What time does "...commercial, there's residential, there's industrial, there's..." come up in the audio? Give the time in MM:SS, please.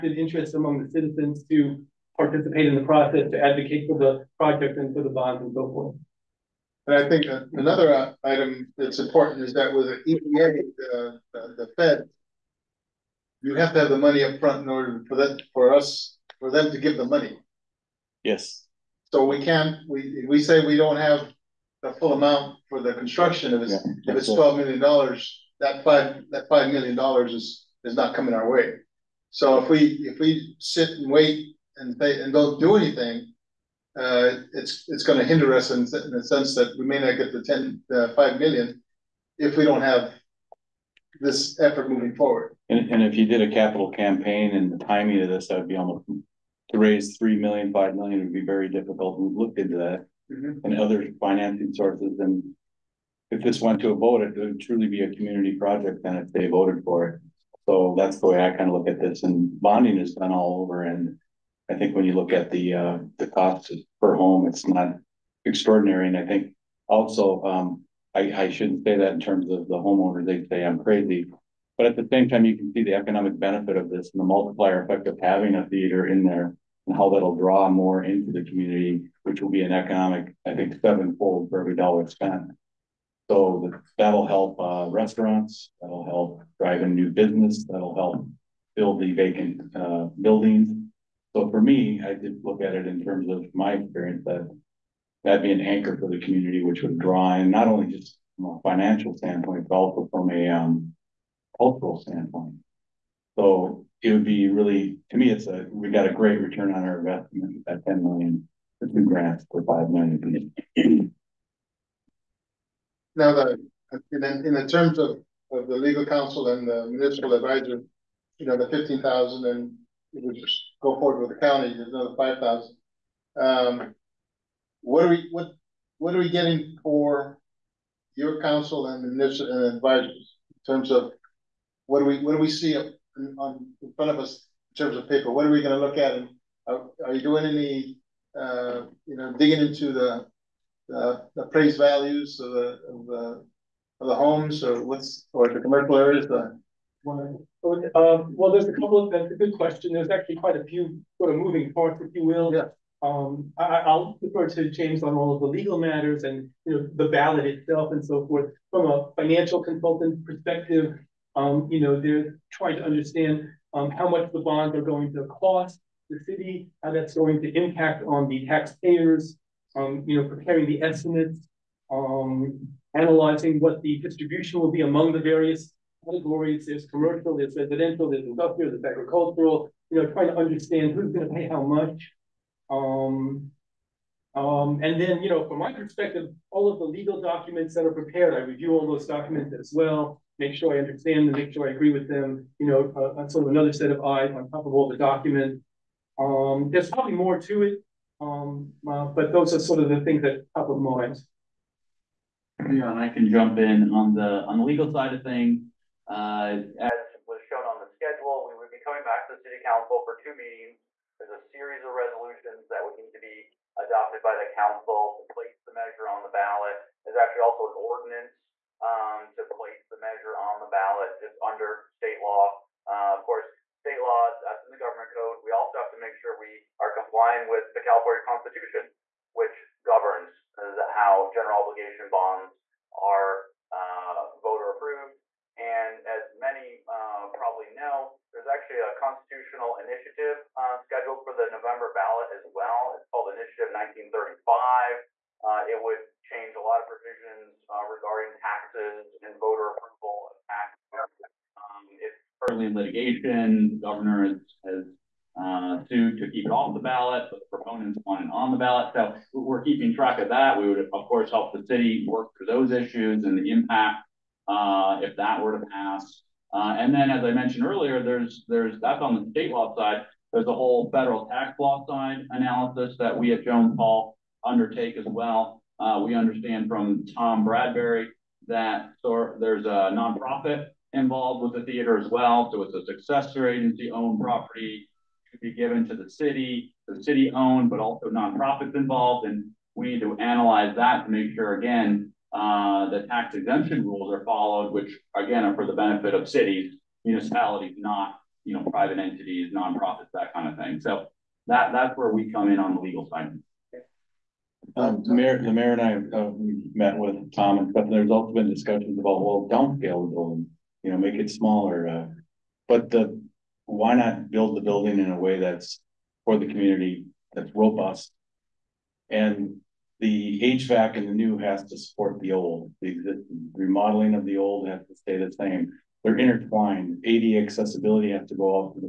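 02:56.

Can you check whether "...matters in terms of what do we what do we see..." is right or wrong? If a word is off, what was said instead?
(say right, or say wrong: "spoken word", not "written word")
wrong: "advisors", not "matters".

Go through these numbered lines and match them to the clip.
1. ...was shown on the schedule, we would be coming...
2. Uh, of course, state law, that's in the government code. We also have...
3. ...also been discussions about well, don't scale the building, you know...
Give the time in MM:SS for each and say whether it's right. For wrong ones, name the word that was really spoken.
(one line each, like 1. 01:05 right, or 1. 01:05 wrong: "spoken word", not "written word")
1. 03:27 right
2. 03:42 right
3. 05:08 right.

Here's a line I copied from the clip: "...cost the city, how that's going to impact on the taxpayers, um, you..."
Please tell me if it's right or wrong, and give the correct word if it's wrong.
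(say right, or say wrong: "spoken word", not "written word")
right.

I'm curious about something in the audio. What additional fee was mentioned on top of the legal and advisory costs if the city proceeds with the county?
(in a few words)
$5,000.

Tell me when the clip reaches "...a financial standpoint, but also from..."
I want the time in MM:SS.
01:38.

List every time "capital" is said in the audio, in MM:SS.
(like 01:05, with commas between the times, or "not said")
00:43.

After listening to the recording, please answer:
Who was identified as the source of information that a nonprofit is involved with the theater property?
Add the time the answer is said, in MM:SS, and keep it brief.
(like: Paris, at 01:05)
Tom Bradbury, at 04:37.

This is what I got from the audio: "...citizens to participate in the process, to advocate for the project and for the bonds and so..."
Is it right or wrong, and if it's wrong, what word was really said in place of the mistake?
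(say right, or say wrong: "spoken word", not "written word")
right.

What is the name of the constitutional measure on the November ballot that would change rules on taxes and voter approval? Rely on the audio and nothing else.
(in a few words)
Initiative 1935.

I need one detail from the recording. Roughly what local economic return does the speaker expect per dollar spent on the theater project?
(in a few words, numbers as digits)
sevenfold.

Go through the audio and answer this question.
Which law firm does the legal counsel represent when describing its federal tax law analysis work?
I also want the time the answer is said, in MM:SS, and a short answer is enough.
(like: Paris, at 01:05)
Jones Hall, at 04:33.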